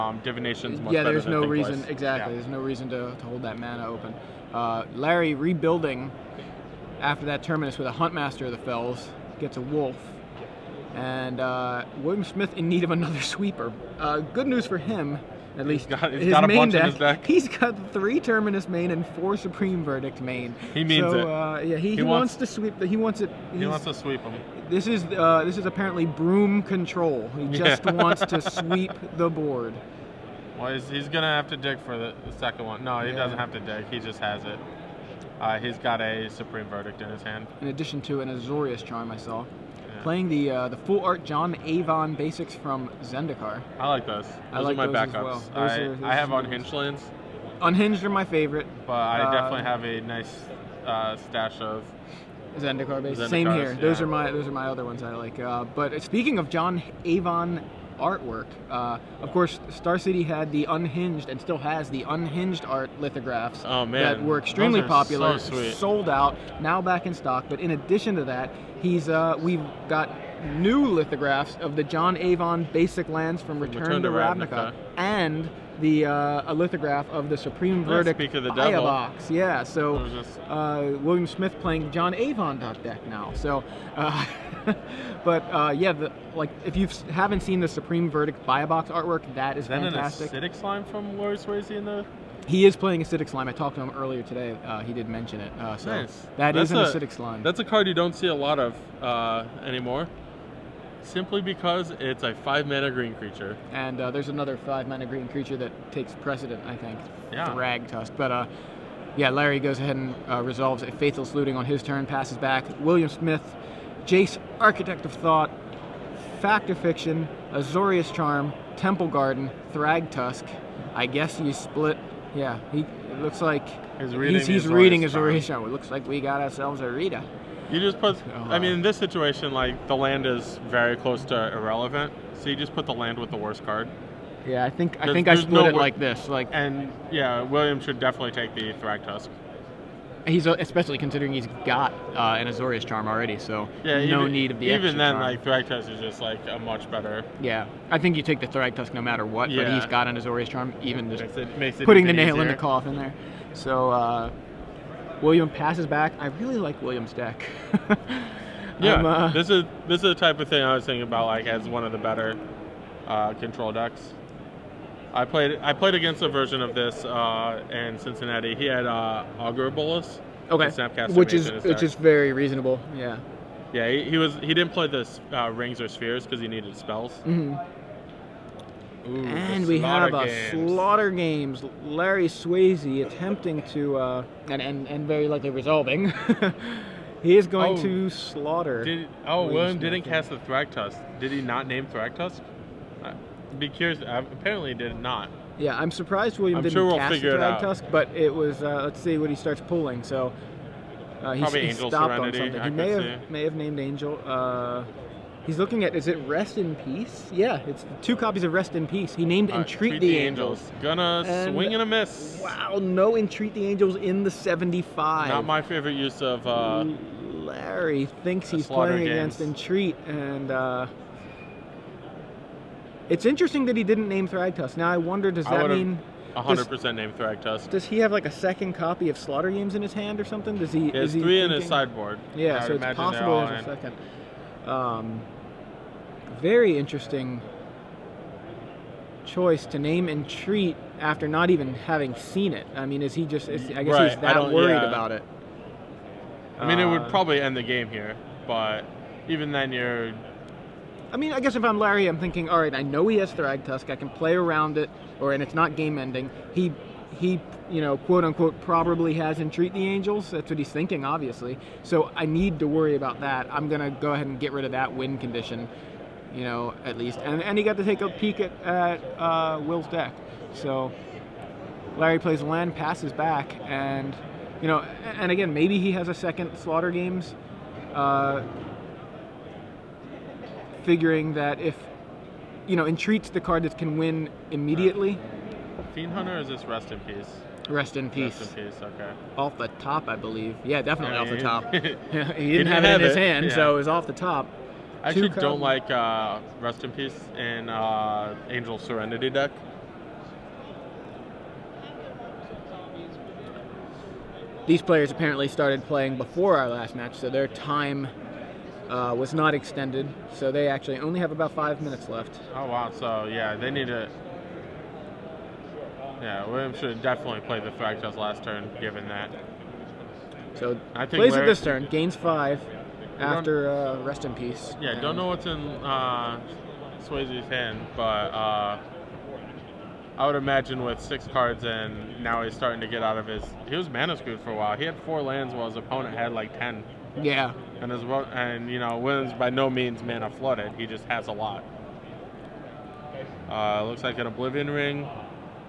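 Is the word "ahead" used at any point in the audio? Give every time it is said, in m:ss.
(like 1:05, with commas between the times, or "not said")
1:49, 4:24.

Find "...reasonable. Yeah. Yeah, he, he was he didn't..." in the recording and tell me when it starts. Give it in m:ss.
2:52.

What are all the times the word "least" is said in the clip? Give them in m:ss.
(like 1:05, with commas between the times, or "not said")
0:15, 4:26.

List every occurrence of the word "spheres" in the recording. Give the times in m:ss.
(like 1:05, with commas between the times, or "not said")
2:55.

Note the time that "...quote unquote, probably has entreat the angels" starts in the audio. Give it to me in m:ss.
4:17.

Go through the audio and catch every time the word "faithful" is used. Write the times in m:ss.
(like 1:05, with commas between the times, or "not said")
1:50.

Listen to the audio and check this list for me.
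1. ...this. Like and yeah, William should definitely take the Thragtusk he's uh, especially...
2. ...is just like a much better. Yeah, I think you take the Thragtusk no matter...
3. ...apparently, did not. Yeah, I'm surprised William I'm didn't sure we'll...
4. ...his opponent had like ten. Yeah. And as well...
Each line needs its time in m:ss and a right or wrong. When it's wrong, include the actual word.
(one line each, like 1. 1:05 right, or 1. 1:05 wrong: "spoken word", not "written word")
1. 2:15 right
2. 2:25 right
3. 3:14 right
4. 5:35 right.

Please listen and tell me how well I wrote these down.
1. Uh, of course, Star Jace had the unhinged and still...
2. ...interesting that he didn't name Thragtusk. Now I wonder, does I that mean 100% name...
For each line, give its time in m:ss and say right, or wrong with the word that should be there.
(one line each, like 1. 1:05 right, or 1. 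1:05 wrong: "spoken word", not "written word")
1. 0:58 wrong: "City", not "Jace"
2. 3:43 right.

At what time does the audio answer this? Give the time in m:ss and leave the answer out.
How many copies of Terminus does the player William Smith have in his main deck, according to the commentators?
0:17.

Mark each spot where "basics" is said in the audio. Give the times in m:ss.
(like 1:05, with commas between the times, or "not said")
0:42, 0:53, 1:12.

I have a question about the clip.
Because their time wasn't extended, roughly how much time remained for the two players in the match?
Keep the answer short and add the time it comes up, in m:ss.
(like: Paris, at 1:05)
5 minutes, at 5:11.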